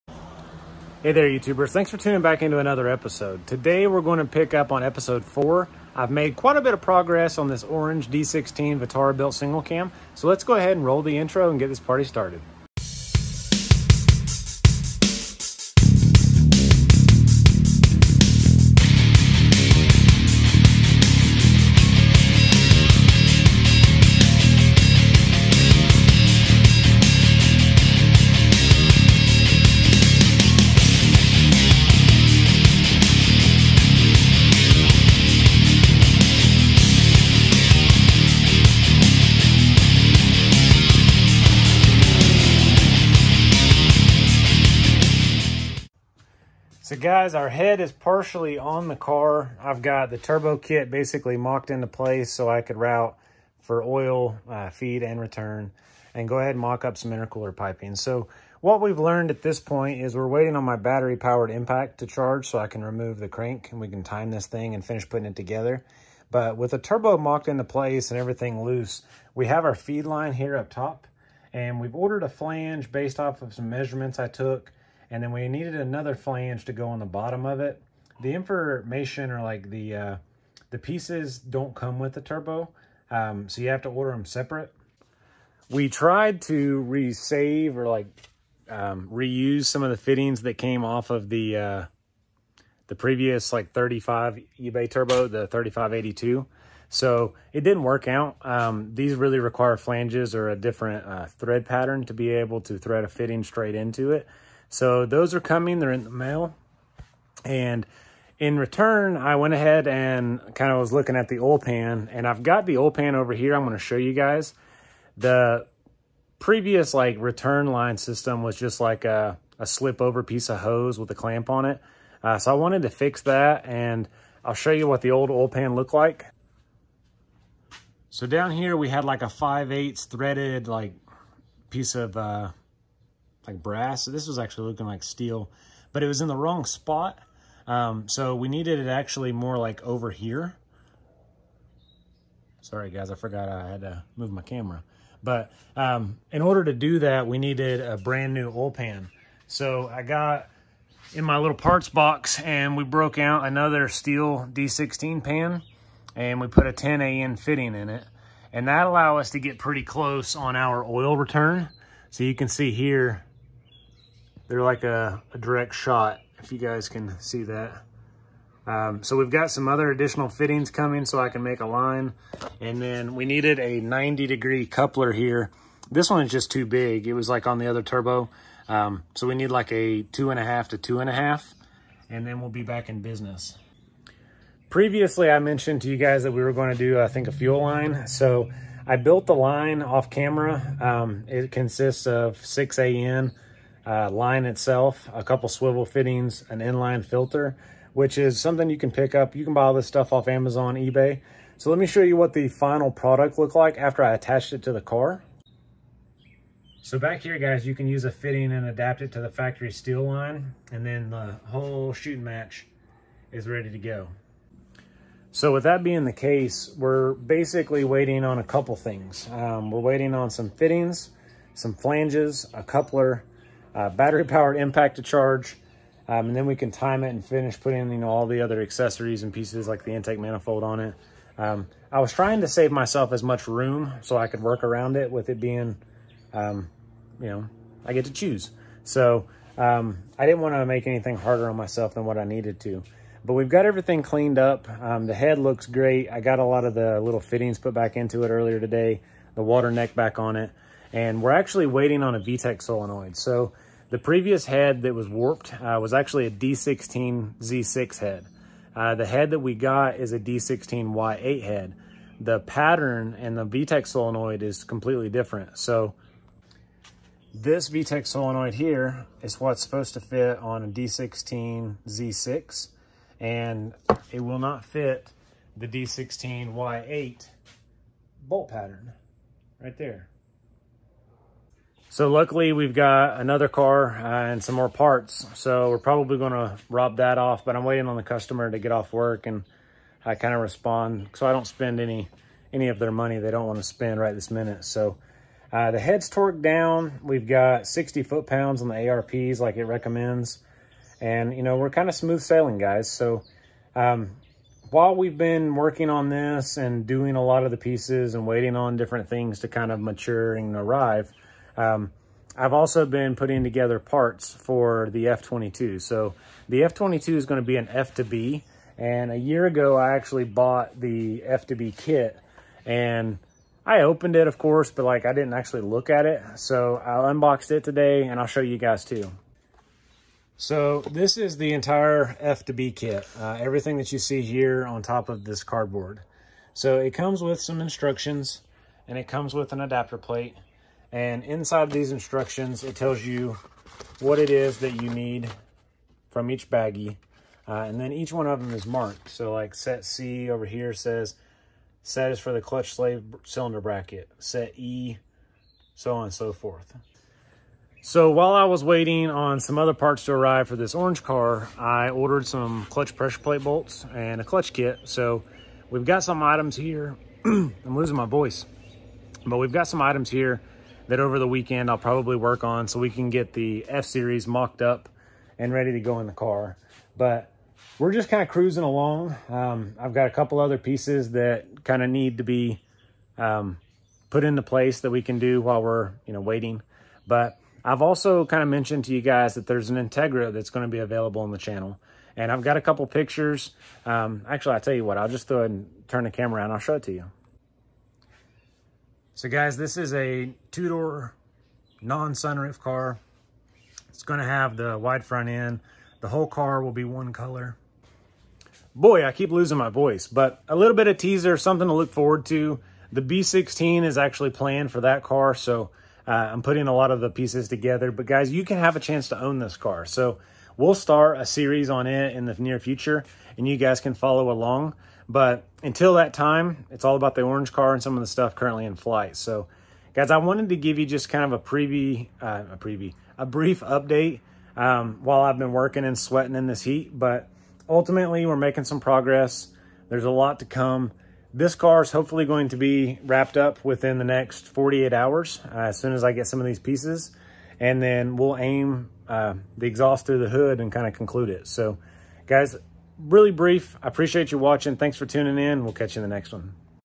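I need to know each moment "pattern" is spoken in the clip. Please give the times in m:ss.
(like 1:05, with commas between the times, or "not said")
1:41, 4:22, 4:38.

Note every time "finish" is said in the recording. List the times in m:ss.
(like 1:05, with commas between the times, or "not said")
1:04, 3:47.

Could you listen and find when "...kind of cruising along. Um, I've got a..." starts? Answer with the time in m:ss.
6:18.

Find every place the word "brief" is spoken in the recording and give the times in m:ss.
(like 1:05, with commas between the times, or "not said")
7:13, 7:33.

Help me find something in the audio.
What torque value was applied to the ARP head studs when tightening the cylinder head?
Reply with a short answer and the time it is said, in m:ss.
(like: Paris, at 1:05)
60 foot pounds, at 4:57.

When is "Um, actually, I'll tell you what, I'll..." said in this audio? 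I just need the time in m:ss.
6:33.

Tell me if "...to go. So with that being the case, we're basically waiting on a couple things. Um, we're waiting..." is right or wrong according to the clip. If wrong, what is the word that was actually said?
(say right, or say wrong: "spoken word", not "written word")
right.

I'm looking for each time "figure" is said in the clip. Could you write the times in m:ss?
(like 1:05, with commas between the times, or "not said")
not said.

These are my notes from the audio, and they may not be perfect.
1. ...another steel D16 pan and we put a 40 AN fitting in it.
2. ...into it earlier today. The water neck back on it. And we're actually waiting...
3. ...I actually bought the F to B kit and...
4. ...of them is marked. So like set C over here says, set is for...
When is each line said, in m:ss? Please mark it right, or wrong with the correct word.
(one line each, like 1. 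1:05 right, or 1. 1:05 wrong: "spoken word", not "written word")
1. 2:33 wrong: "10", not "40"
2. 4:07 right
3. 5:19 right
4. 5:48 right.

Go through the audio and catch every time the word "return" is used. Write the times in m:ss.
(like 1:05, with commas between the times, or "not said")
0:55, 1:48, 1:57, 2:41.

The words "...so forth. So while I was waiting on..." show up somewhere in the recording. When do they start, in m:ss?
5:56.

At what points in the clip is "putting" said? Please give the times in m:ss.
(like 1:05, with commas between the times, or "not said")
1:05, 3:47, 5:13, 6:56.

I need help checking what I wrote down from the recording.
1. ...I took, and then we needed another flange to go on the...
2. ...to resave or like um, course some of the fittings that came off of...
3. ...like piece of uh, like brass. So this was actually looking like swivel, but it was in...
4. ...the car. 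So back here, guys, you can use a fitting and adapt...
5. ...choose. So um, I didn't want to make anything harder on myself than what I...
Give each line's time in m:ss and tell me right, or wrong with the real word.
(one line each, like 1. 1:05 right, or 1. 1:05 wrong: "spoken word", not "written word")
1. 1:14 right
2. 1:26 wrong: "reuse", not "course"
3. 2:10 wrong: "steel", not "swivel"
4. 3:24 right
5. 3:58 right.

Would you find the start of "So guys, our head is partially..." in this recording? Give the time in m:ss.
0:46.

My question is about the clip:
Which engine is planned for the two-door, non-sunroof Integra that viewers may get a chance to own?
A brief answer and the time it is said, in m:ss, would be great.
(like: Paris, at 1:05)
B16, at 6:53.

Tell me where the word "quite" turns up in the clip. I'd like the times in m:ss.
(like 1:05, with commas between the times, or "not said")
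0:06.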